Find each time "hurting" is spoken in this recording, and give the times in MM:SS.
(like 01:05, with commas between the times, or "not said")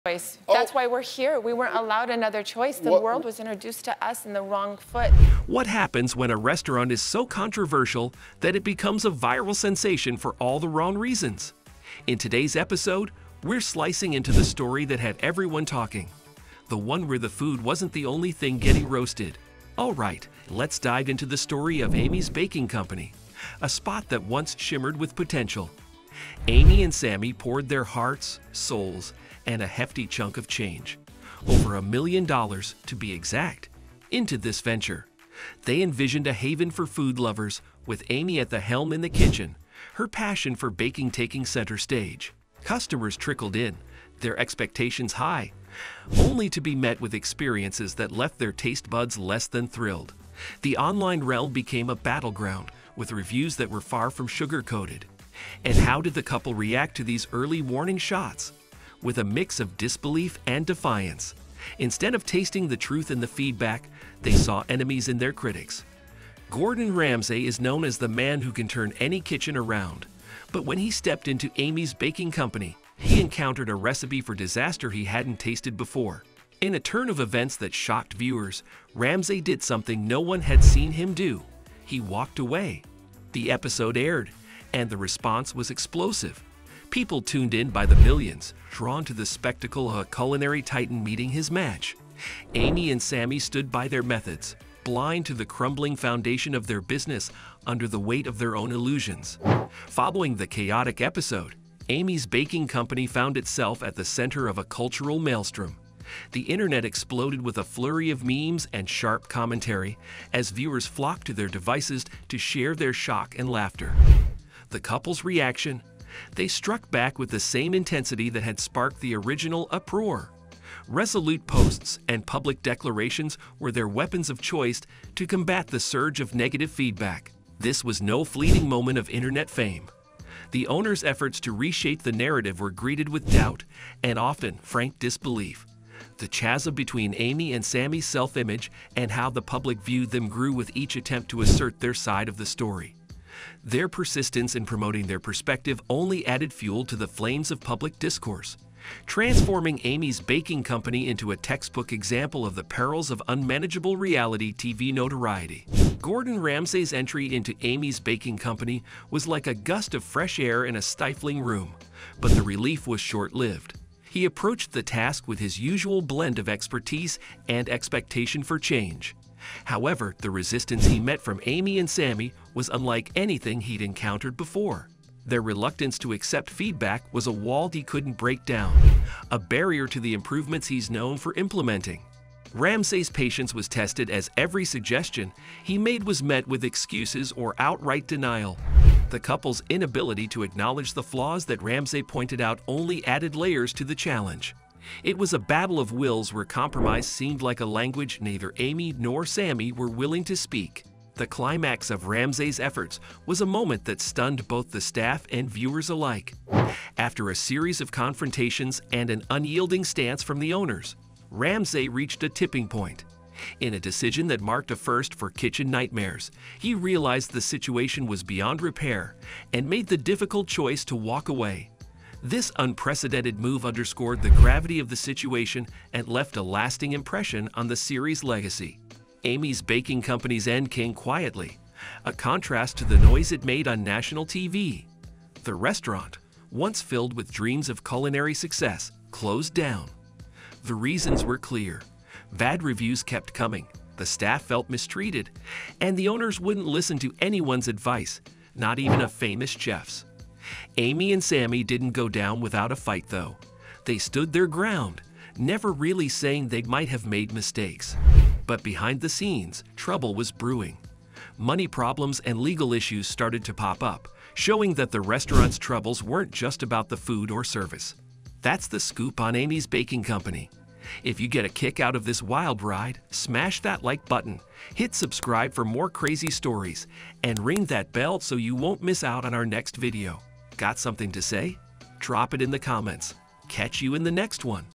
not said.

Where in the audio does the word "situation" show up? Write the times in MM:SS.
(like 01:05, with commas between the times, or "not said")
03:37, 03:44.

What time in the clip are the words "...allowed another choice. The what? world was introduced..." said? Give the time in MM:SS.
00:01.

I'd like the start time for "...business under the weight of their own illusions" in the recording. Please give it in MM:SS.
01:36.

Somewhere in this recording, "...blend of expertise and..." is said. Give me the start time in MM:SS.
02:46.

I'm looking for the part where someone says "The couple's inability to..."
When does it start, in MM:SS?
03:09.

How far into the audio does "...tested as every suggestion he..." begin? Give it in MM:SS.
03:03.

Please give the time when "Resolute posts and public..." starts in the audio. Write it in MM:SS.
02:00.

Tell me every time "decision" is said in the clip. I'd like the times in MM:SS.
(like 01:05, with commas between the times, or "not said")
03:33.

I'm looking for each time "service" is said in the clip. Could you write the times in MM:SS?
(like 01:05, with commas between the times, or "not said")
04:27.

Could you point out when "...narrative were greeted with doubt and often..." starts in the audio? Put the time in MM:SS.
02:12.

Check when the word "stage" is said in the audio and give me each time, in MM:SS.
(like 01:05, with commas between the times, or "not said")
00:41.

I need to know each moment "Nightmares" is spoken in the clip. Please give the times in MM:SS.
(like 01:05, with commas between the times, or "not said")
03:35.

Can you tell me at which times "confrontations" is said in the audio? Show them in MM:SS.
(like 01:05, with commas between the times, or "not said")
03:27.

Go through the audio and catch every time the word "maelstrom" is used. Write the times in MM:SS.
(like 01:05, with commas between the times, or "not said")
01:45.